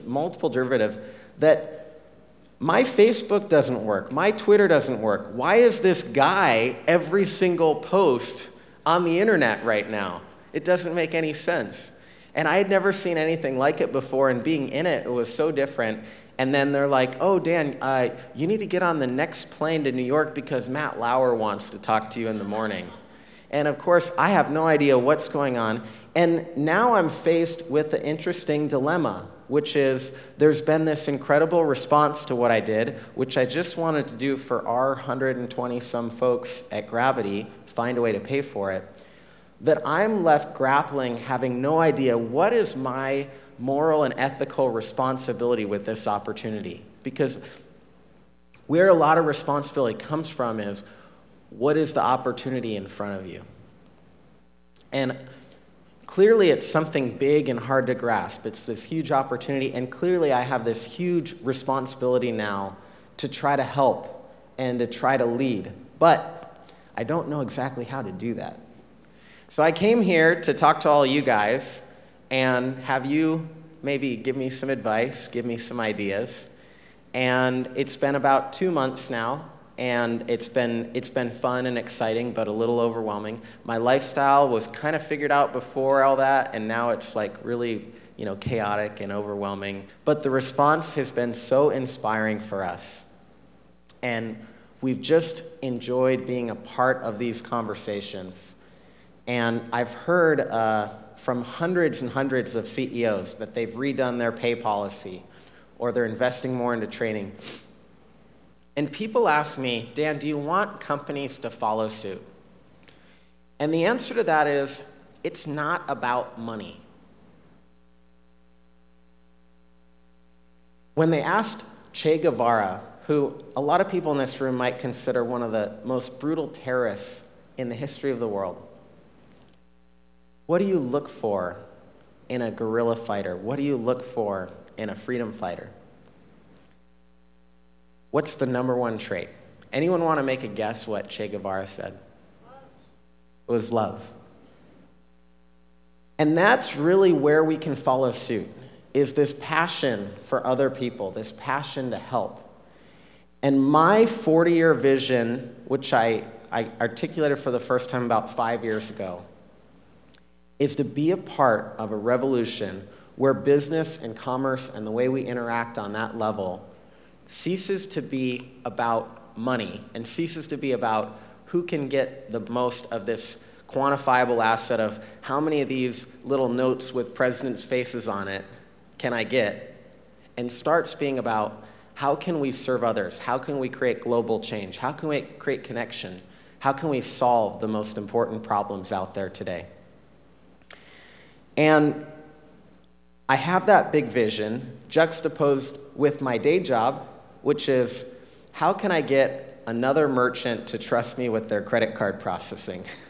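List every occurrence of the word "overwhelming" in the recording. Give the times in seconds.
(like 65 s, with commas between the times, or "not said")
82 s, 89 s.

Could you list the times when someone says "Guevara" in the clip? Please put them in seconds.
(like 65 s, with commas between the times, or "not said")
122 s, 141 s.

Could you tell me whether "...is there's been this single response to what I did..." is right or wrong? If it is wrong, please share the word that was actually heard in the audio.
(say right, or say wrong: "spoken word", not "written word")
wrong: "incredible", not "single".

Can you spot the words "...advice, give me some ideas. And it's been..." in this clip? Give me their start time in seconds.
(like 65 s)
74 s.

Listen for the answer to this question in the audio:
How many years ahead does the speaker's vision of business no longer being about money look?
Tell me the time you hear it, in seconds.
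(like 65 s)
154 s.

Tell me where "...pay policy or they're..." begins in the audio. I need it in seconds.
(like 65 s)
104 s.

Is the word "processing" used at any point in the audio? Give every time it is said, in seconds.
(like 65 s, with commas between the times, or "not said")
202 s.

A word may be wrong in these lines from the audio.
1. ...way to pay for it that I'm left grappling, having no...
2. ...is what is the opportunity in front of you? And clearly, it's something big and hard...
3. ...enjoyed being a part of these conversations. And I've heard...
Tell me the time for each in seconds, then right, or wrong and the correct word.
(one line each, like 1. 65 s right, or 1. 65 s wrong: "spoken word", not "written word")
1. 38 s right
2. 50 s right
3. 95 s right.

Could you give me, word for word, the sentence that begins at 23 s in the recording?
And of course, I have no idea what's going on.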